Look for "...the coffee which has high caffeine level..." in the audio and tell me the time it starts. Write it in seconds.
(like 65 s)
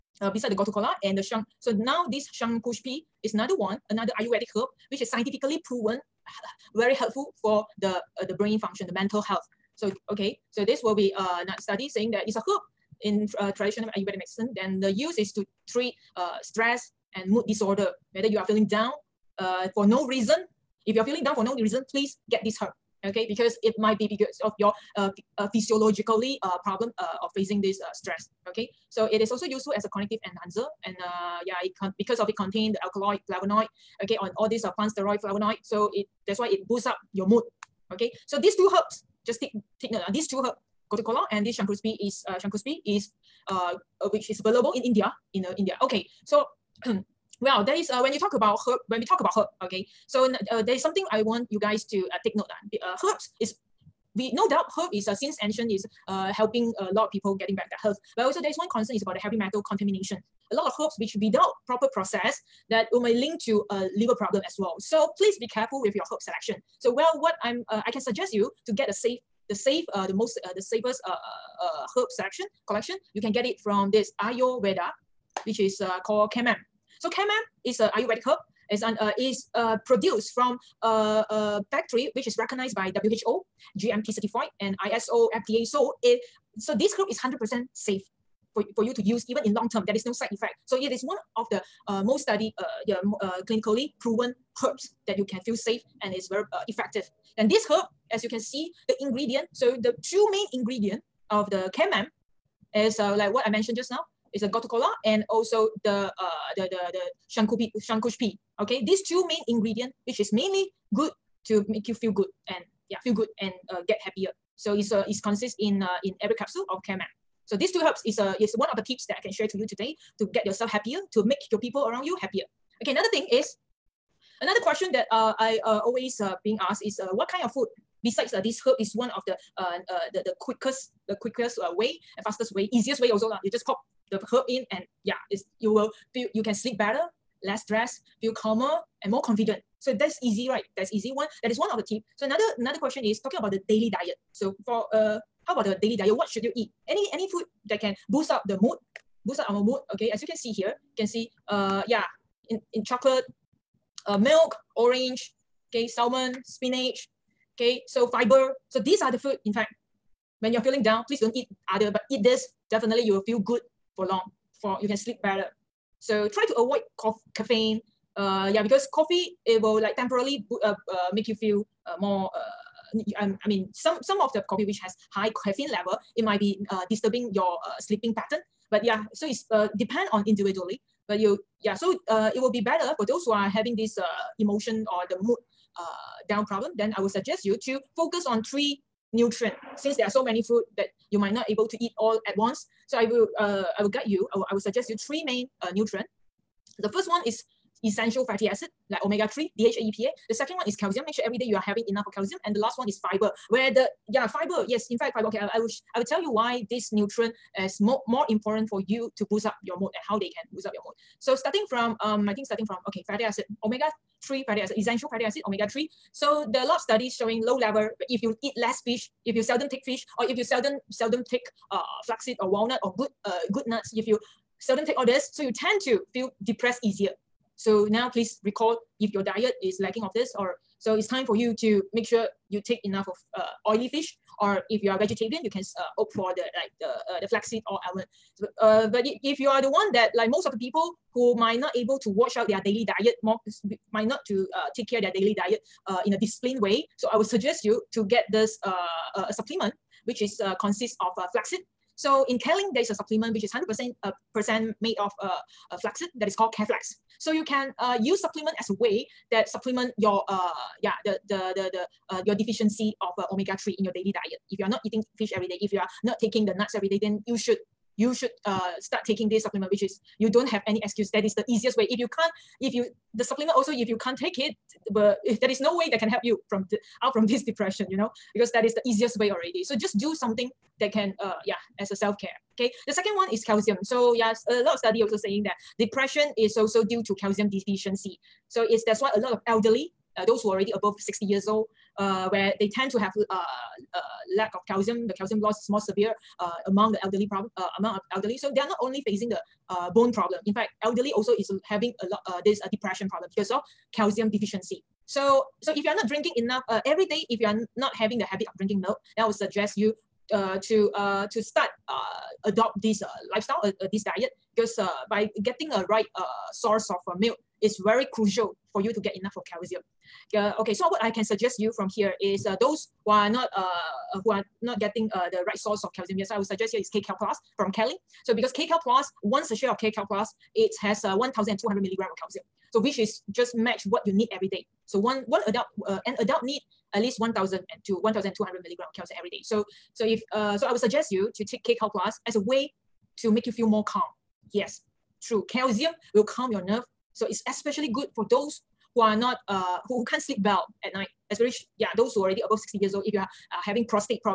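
174 s.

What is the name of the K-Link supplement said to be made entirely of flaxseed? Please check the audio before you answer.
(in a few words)
Careflex.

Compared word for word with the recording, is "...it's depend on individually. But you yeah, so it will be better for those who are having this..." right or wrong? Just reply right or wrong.
right.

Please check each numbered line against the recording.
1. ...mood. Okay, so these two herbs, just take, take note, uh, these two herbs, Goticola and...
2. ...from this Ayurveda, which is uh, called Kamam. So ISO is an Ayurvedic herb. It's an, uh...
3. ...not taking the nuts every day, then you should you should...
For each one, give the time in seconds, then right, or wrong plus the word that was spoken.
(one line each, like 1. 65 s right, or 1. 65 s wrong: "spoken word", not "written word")
1. 37 s right
2. 73 s wrong: "Kamam", not "ISO"
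3. 266 s right.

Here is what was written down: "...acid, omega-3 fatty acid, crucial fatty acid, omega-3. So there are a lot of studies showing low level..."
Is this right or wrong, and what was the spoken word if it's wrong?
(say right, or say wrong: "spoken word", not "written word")
wrong: "essential", not "crucial".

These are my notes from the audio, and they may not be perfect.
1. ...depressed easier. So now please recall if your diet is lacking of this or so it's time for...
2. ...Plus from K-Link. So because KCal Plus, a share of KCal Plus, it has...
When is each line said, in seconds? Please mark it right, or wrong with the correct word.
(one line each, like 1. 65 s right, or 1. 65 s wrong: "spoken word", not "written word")
1. 226 s right
2. 327 s right.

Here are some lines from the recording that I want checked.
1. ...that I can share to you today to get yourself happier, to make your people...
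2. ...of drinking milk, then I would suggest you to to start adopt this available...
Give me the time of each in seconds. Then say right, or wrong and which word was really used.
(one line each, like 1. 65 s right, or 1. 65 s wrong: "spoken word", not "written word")
1. 119 s right
2. 308 s wrong: "lifestyle", not "available".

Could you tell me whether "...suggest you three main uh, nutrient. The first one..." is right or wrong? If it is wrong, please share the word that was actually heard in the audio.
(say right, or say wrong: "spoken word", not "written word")
right.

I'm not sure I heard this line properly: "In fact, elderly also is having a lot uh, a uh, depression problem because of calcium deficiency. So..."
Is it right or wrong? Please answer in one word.
right.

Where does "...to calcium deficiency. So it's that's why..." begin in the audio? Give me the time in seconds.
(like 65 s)
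287 s.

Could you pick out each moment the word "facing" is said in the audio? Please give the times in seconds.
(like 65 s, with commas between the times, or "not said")
27 s, 299 s.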